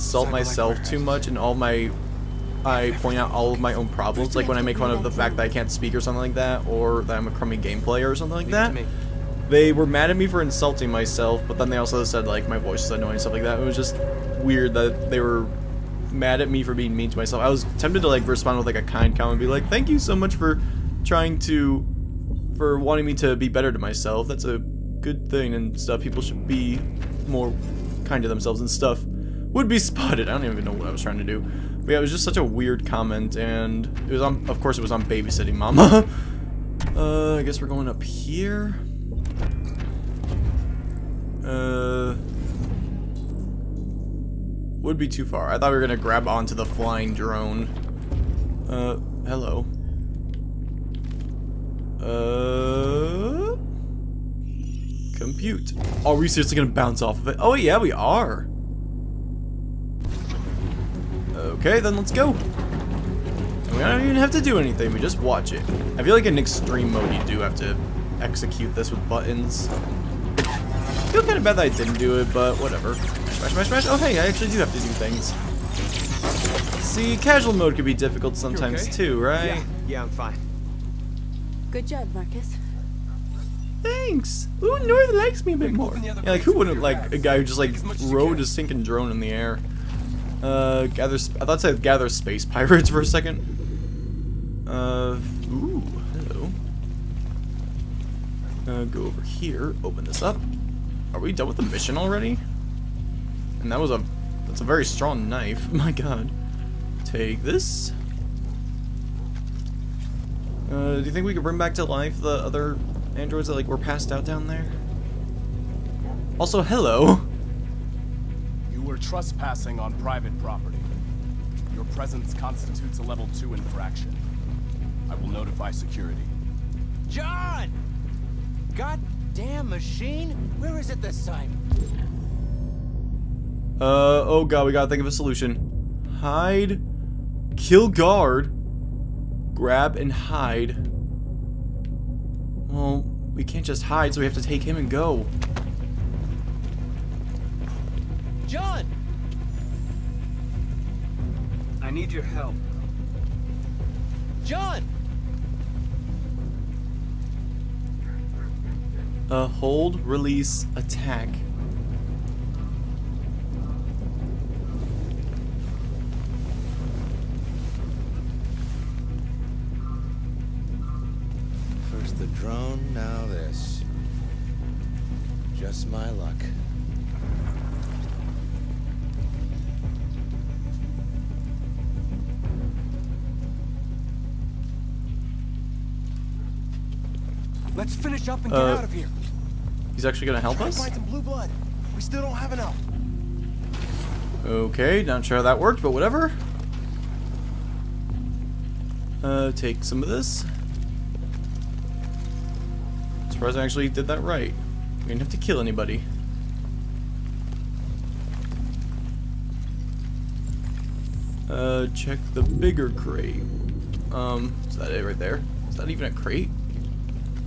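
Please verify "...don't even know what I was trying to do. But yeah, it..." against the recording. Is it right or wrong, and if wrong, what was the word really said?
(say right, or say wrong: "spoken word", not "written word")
right.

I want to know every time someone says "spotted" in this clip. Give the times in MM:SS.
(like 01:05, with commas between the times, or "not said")
00:29.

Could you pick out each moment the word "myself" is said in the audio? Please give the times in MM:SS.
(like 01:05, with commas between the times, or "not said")
00:00, 00:10, 00:17, 00:23.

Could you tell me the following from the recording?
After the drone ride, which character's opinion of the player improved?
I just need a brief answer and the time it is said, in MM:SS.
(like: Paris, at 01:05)
North, at 01:24.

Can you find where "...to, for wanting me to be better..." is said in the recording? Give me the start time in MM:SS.
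00:21.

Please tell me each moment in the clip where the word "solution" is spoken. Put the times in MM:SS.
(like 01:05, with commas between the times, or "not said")
02:15.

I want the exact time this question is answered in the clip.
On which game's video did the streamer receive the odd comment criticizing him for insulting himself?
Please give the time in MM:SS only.
00:35.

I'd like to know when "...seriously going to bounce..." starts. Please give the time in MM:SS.
00:56.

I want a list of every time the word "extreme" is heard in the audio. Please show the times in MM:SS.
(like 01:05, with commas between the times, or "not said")
01:06.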